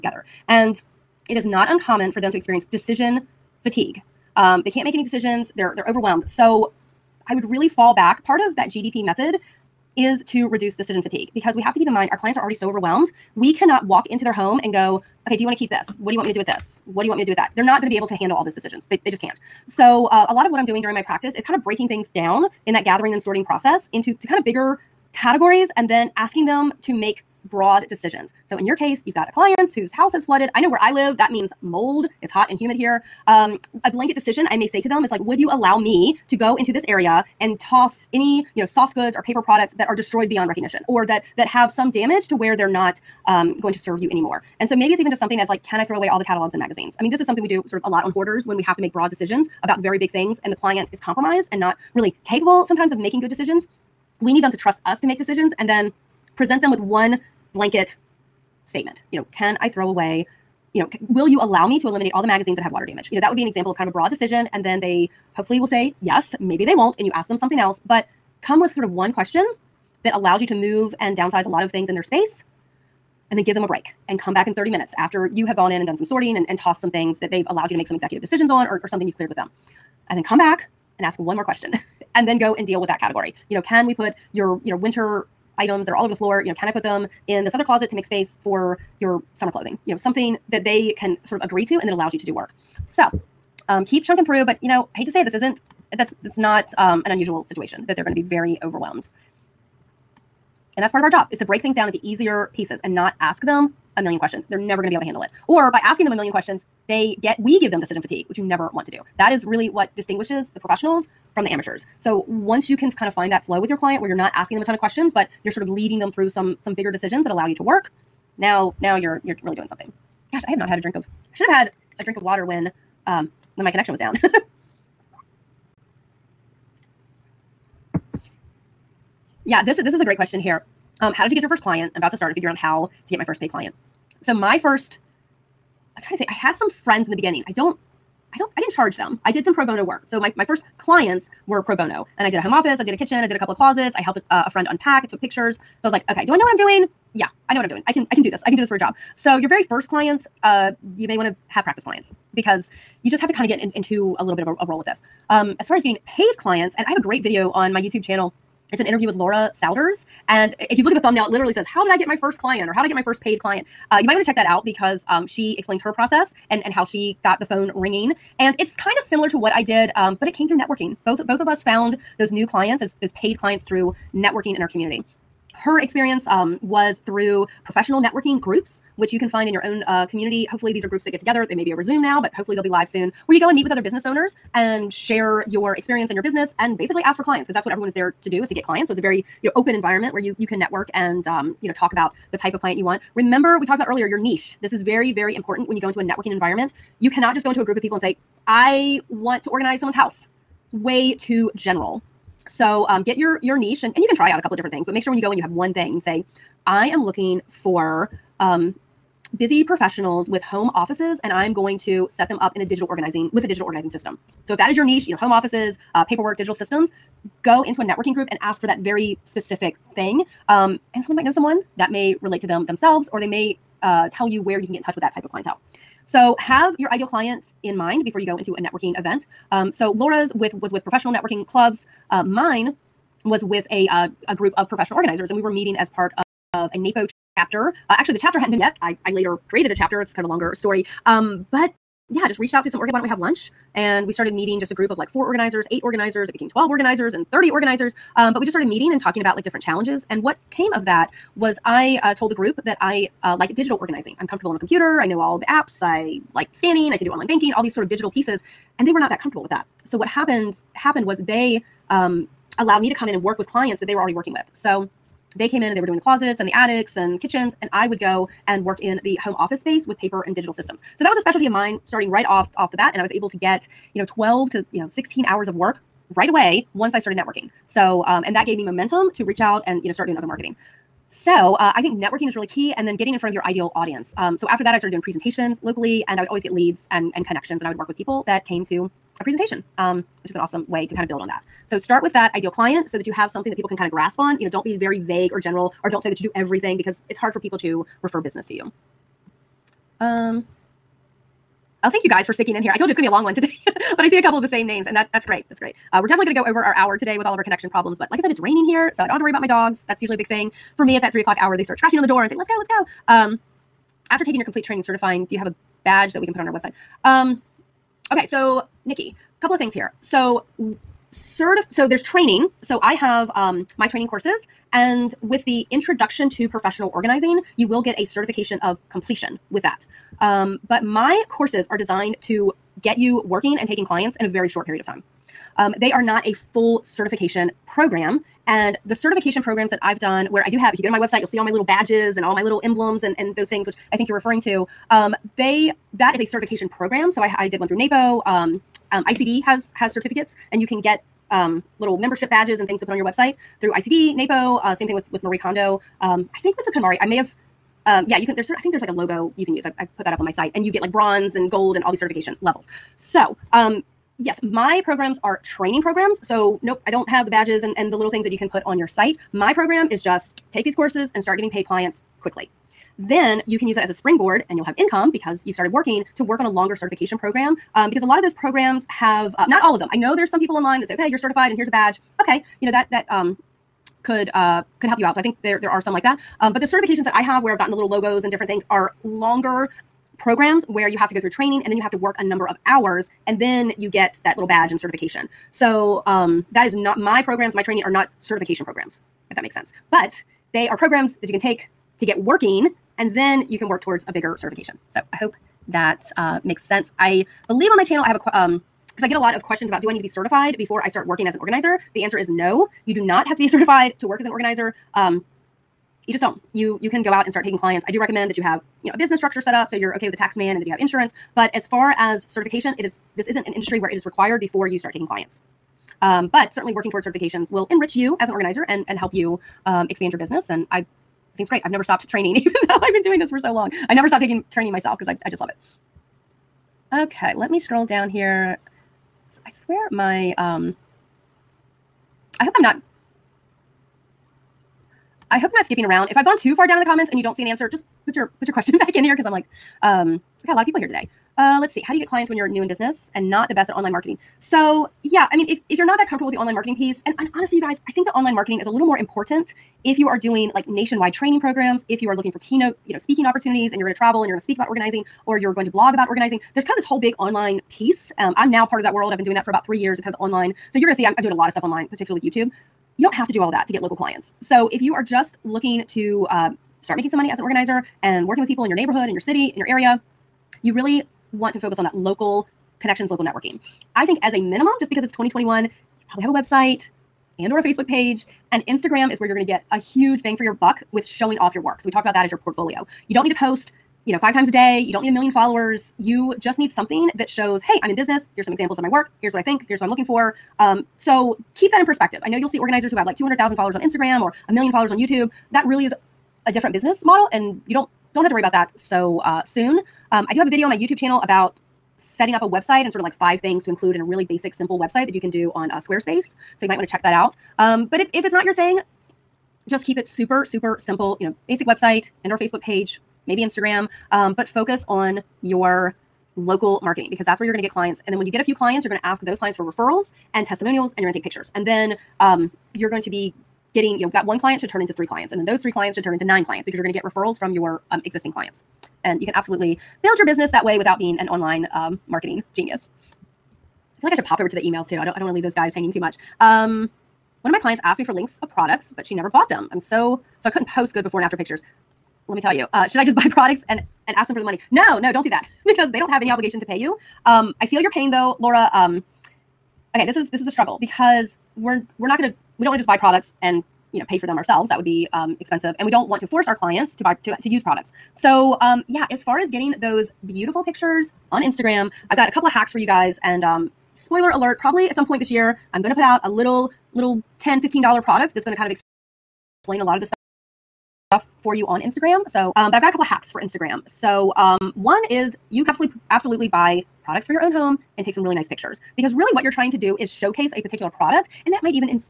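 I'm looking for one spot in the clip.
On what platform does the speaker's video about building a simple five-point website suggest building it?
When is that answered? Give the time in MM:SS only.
08:35.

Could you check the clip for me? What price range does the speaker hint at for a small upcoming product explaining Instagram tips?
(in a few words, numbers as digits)
$10 to $15.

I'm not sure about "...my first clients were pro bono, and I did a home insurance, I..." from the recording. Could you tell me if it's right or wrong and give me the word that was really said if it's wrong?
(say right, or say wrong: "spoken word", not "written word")
wrong: "office", not "insurance".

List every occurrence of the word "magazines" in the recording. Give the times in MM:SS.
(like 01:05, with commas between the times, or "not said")
00:46, 01:02.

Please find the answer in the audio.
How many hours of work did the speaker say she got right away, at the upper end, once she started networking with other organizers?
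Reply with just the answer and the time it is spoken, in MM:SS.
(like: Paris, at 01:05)
16 hours, at 04:34.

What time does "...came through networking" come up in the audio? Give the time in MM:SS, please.
02:50.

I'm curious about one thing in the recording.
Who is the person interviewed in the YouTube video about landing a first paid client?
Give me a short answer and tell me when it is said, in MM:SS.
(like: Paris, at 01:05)
Laura Souders, at 02:39.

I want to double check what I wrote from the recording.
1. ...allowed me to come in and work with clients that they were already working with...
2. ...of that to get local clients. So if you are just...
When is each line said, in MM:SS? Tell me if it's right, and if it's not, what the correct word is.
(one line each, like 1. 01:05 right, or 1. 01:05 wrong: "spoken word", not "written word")
1. 04:22 right
2. 07:53 right.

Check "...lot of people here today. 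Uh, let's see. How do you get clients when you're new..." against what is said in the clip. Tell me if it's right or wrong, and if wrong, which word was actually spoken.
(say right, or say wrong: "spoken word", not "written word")
right.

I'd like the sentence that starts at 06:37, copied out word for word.
My training are not certification programs, if that makes sense.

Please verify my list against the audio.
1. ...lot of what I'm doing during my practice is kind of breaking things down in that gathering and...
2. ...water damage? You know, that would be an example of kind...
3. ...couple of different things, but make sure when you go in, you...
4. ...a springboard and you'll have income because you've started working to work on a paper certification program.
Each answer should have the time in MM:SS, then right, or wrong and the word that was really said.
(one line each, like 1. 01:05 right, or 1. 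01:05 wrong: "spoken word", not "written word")
1. 00:20 right
2. 01:02 right
3. 03:24 right
4. 06:13 wrong: "longer", not "paper".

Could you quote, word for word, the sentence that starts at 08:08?
And Instagram is where you're going to get a huge bang for your buck with showing off your work.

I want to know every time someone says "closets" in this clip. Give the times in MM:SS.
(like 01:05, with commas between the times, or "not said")
01:27, 02:23, 04:25.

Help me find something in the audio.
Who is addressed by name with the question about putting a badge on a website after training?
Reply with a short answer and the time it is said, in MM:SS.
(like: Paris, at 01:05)
Nikki, at 05:18.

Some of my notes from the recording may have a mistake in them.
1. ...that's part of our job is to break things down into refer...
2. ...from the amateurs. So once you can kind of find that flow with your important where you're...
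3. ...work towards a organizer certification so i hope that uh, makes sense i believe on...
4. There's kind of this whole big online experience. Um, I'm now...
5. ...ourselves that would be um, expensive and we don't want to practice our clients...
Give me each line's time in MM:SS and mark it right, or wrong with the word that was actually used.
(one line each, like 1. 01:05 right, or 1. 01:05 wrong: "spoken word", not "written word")
1. 01:40 wrong: "easier", not "refer"
2. 01:51 wrong: "client", not "important"
3. 06:43 wrong: "bigger", not "organizer"
4. 07:46 wrong: "piece", not "experience"
5. 09:24 wrong: "force", not "practice".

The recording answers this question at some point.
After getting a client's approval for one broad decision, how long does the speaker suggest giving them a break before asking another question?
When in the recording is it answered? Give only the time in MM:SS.
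01:14.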